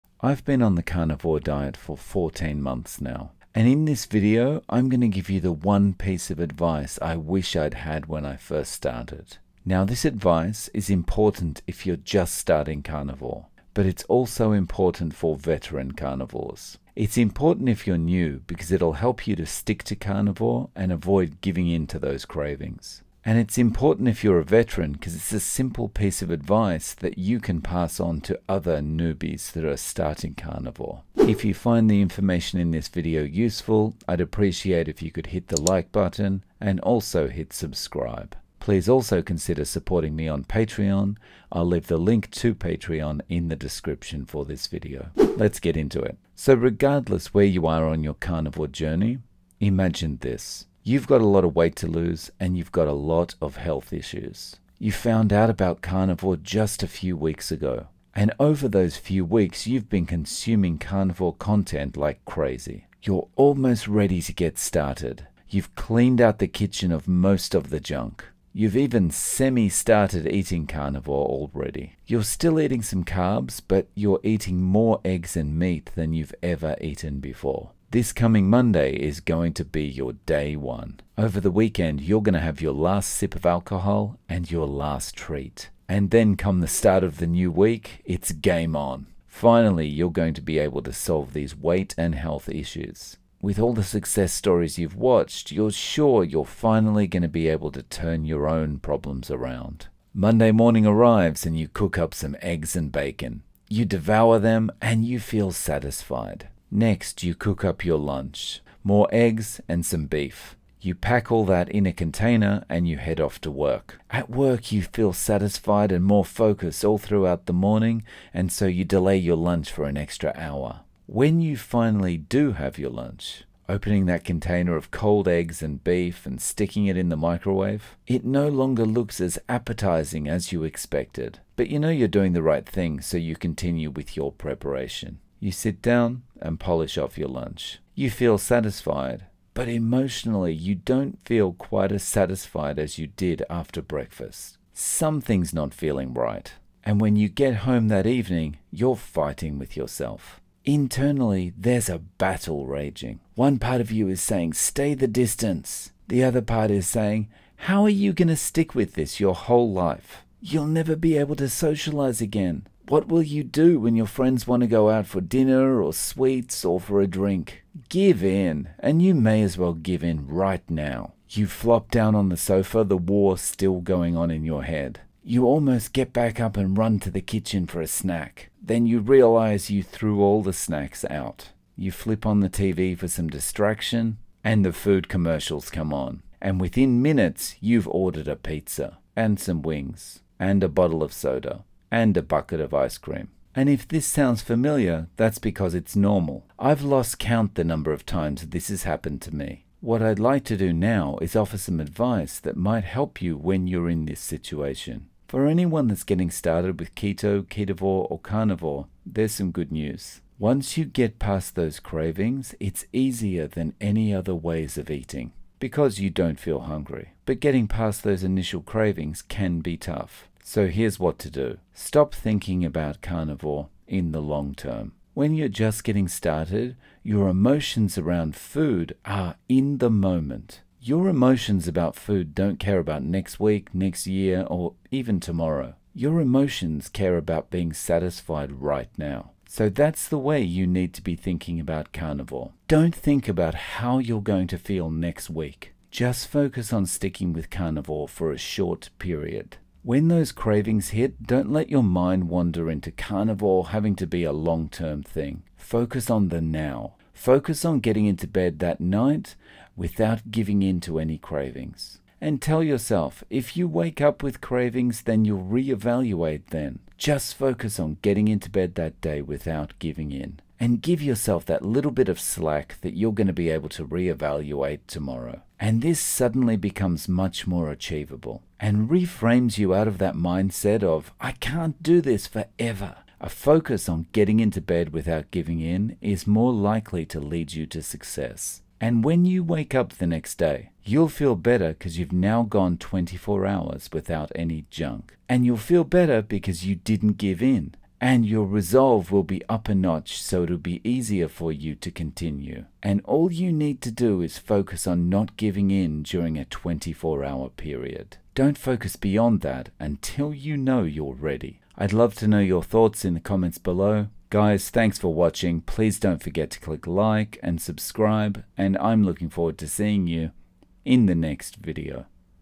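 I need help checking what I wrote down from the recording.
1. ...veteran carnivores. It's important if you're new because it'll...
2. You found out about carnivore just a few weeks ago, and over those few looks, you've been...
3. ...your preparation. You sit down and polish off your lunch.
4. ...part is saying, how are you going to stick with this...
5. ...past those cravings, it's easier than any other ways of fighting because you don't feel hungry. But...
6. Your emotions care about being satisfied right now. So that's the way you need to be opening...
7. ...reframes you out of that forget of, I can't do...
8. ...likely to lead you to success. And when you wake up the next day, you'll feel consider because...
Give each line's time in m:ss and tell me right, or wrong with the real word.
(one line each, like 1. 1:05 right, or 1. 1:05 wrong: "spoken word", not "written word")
1. 0:15 right
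2. 0:54 wrong: "weeks", not "looks"
3. 2:14 right
4. 2:36 right
5. 3:31 wrong: "eating", not "fighting"
6. 3:55 wrong: "thinking", not "opening"
7. 4:38 wrong: "mindset", not "forget"
8. 4:46 wrong: "better", not "consider".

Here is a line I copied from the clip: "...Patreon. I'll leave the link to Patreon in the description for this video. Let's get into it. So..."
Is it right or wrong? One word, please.
right.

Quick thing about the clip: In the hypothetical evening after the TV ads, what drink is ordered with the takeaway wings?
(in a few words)
A bottle of soda.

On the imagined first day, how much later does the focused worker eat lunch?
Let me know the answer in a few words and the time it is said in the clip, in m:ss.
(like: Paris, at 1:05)
An extra hour, at 1:59.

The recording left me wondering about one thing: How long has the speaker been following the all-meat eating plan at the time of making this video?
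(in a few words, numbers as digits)
14 months.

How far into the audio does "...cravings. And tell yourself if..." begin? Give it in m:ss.
4:21.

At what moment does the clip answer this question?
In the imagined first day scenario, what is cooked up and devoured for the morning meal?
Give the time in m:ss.
1:42.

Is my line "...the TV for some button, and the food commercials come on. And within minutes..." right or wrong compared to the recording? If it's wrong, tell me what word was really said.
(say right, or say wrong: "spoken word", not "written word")
wrong: "distraction", not "button".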